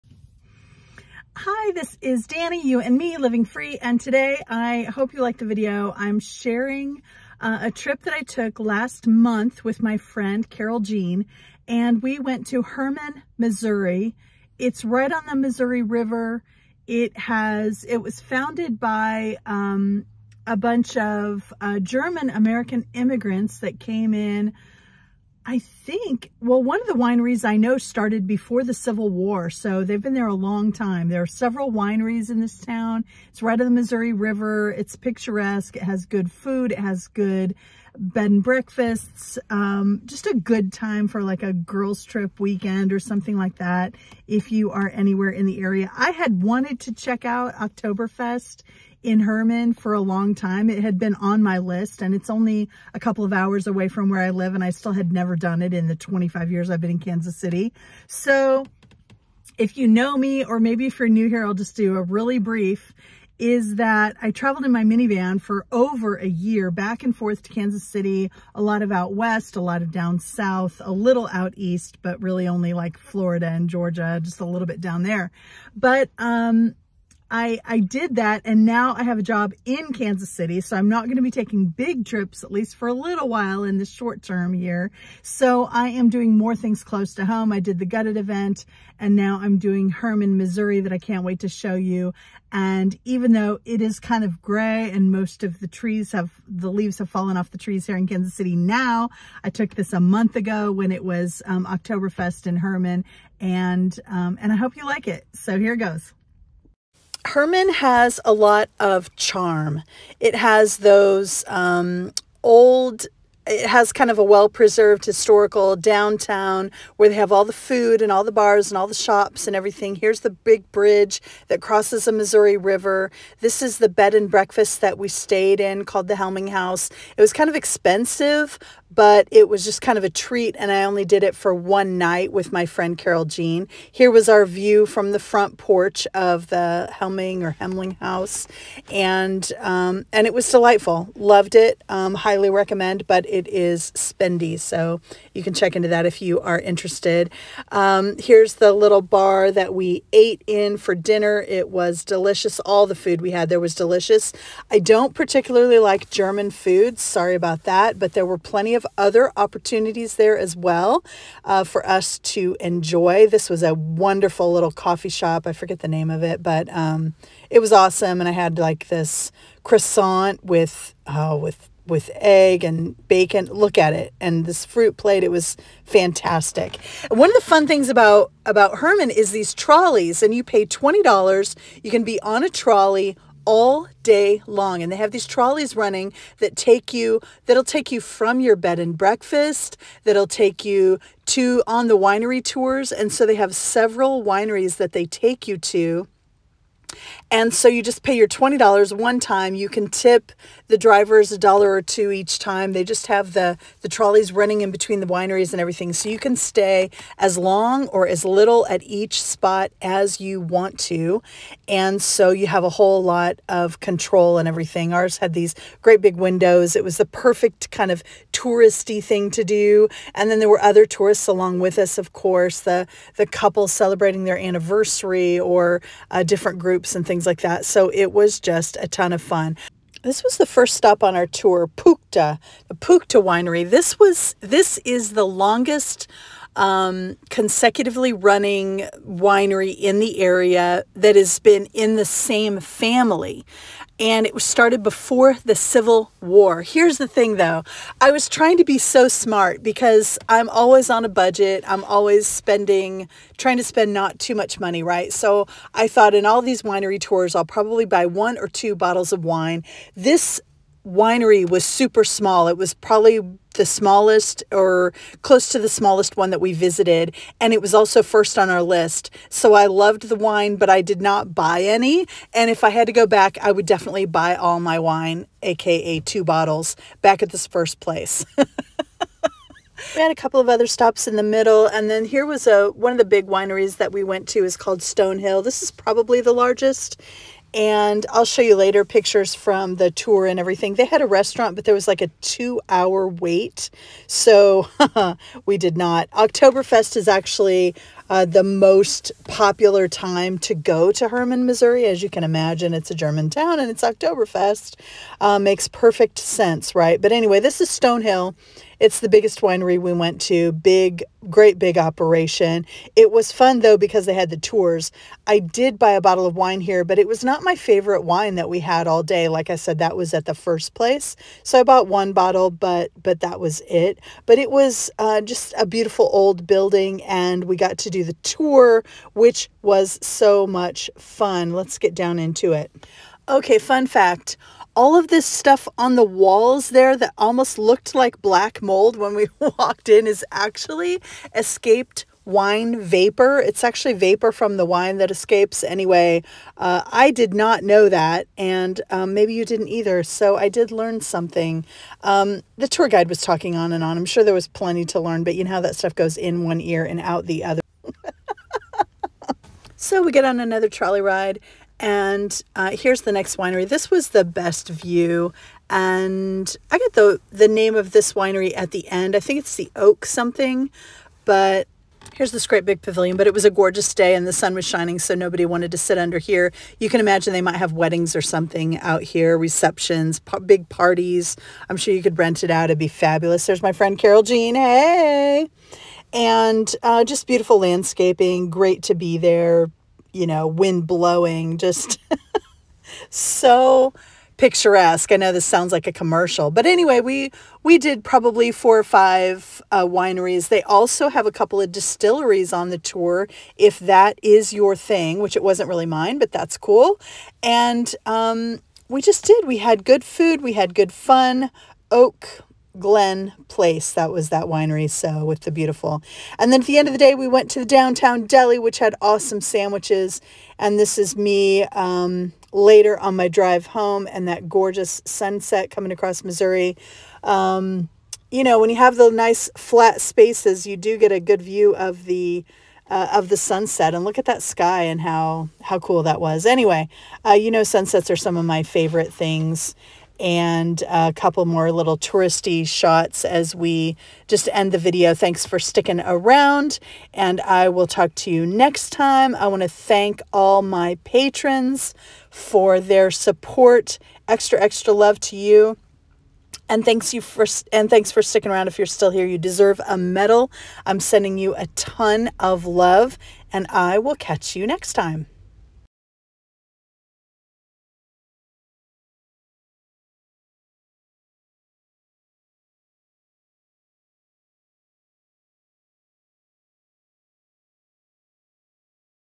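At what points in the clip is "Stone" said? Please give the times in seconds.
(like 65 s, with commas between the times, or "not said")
284 s, 307 s.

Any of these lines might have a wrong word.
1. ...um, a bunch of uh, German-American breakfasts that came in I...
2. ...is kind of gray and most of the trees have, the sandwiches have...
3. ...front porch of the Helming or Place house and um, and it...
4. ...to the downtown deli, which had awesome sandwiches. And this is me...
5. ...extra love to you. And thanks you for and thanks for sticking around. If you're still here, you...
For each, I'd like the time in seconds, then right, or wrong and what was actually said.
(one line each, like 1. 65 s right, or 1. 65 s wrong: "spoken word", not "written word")
1. 19 s wrong: "immigrants", not "breakfasts"
2. 93 s wrong: "leaves", not "sandwiches"
3. 135 s wrong: "Hemling", not "Place"
4. 417 s right
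5. 454 s right.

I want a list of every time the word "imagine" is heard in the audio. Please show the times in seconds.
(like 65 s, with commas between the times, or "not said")
302 s, 376 s.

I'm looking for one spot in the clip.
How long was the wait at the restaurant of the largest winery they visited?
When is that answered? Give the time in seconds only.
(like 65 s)
292 s.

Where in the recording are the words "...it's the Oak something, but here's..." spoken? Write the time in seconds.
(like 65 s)
369 s.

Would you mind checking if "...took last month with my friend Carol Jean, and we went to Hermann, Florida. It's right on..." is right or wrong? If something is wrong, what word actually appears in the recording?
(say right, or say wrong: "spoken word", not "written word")
wrong: "Missouri", not "Florida".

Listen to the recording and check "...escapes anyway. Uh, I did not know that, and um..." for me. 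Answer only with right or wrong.
right.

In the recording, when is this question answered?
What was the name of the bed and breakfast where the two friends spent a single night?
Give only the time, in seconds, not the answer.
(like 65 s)
126 s.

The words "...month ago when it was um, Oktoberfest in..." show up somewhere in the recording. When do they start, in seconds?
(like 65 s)
100 s.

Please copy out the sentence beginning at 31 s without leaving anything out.
There are several wineries in this town.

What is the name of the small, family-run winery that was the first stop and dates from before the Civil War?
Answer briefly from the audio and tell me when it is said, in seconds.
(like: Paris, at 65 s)
Puchta Winery, at 232 s.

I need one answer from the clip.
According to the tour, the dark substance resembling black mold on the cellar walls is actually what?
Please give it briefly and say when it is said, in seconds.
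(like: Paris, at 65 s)
Escaped wine vapor, at 341 s.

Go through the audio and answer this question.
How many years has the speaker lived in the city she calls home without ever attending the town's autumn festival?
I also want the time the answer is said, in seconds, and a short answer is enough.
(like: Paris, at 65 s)
25, at 55 s.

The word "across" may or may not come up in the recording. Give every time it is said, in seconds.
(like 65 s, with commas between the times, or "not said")
425 s.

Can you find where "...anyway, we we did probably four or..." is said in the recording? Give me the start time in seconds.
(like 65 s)
396 s.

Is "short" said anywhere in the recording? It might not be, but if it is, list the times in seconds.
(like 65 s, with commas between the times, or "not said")
83 s.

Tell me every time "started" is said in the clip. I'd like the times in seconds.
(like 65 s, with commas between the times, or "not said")
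27 s, 244 s.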